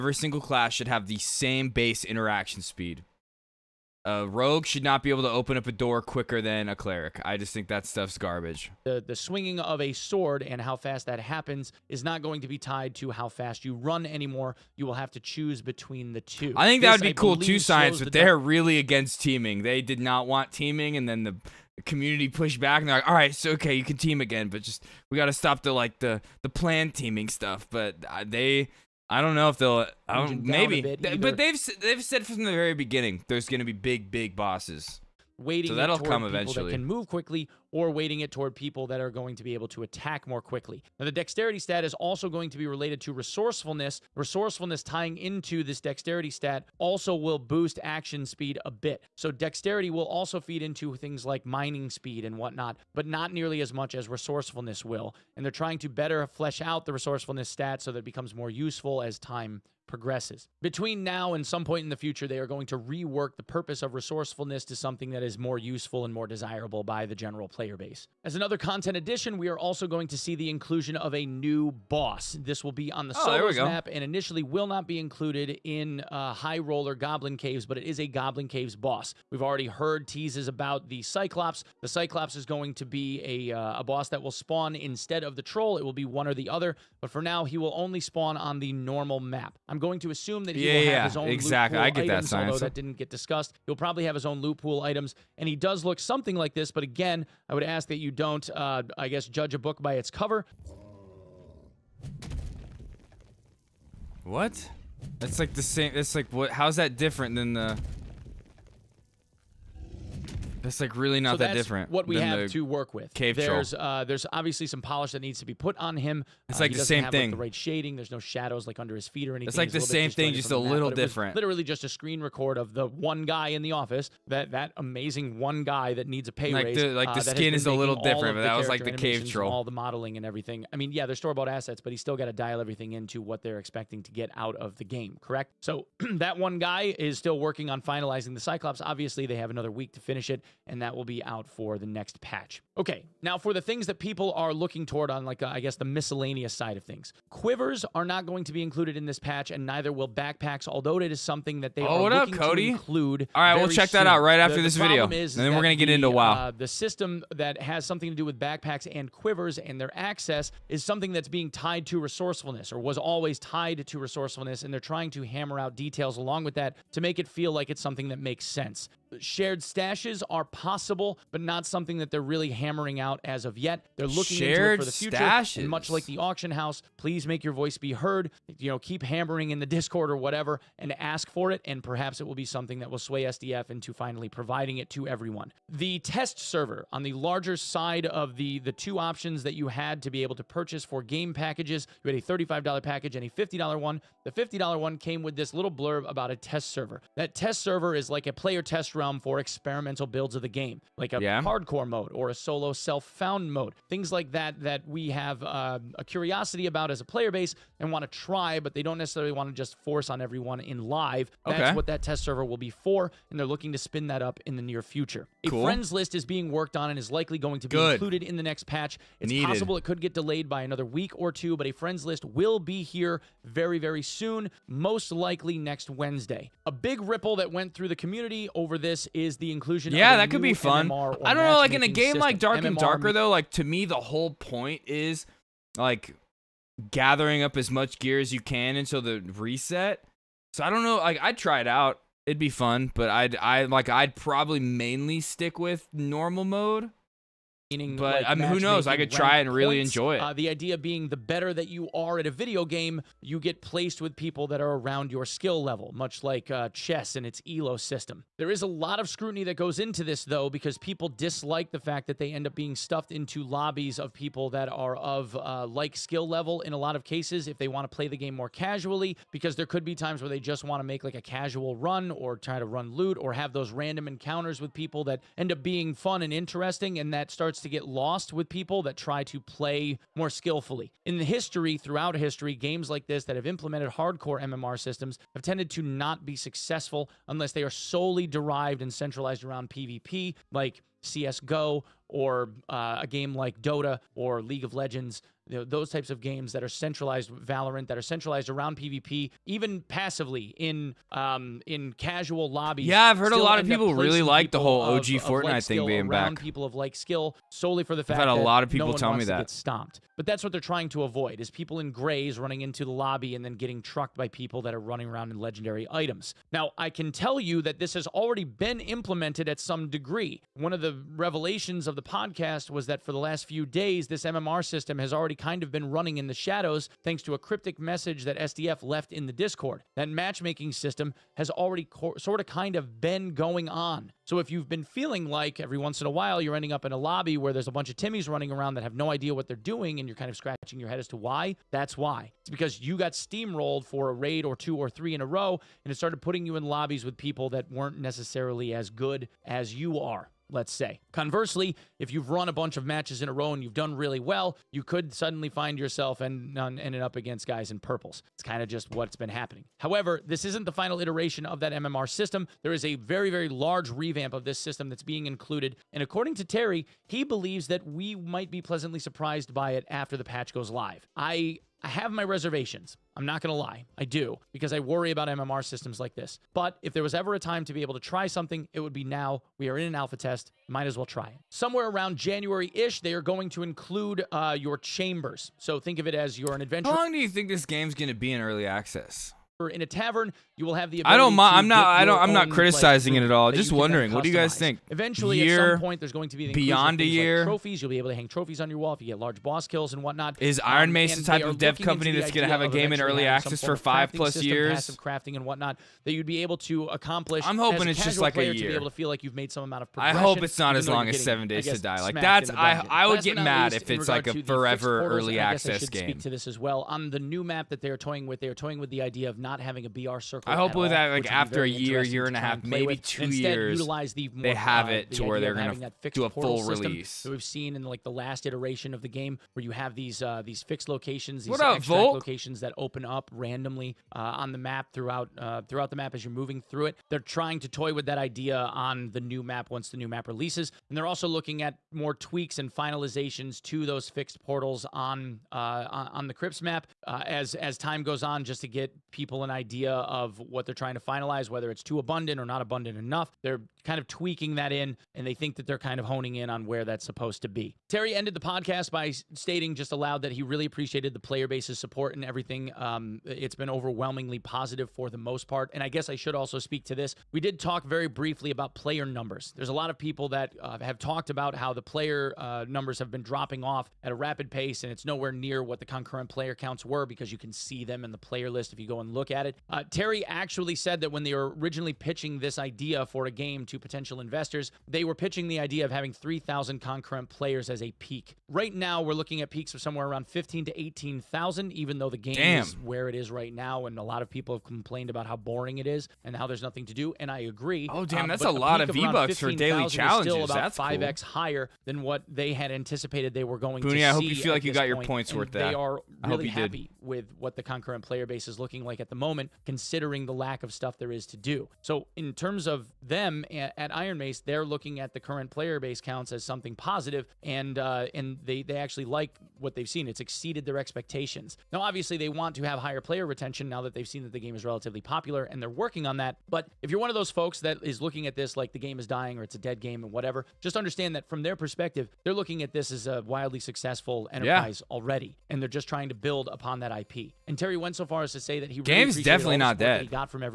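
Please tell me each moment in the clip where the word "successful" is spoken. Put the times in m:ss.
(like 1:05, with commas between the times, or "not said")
4:46, 8:53.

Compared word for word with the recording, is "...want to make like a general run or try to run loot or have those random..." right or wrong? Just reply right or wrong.
wrong.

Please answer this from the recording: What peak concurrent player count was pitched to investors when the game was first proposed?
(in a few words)
3,000.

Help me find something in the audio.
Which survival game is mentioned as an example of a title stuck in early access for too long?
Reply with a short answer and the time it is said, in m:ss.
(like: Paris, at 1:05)
Seven Days to Die, at 6:51.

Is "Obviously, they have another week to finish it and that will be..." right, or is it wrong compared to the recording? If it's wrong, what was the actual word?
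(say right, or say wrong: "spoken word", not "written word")
right.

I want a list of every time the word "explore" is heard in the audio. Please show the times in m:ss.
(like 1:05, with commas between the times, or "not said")
not said.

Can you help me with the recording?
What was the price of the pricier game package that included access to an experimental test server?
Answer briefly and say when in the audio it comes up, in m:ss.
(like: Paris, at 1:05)
$50, at 3:13.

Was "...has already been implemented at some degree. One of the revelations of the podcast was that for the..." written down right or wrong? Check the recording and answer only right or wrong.
right.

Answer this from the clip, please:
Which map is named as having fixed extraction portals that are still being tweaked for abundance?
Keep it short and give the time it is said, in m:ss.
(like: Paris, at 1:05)
Crypts, at 7:26.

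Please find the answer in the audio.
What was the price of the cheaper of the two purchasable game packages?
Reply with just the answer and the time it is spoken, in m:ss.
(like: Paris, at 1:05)
$35, at 3:12.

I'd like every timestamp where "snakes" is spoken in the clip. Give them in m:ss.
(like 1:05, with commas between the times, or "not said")
not said.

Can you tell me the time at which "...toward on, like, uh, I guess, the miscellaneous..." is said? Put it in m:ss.
2:24.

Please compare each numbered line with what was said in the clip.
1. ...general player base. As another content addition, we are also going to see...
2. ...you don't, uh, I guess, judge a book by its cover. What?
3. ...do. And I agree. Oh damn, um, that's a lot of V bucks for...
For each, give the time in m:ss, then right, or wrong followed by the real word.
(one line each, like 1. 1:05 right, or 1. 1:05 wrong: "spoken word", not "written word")
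1. 1:07 right
2. 1:37 right
3. 8:16 right.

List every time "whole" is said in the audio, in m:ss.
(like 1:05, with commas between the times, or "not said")
3:53, 5:04.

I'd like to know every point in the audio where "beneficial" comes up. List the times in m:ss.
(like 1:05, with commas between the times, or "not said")
not said.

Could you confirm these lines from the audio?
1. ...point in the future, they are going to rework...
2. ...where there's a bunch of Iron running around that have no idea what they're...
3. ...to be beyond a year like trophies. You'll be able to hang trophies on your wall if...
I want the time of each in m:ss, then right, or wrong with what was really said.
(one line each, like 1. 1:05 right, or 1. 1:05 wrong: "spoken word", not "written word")
1. 1:01 right
2. 5:37 wrong: "Timmys", not "Iron"
3. 6:36 right.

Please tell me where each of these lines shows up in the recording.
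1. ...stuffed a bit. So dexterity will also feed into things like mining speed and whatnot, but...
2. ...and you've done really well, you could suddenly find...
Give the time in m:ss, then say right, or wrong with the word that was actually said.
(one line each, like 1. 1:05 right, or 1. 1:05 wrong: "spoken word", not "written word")
1. 0:48 wrong: "speed", not "stuffed"
2. 5:53 right.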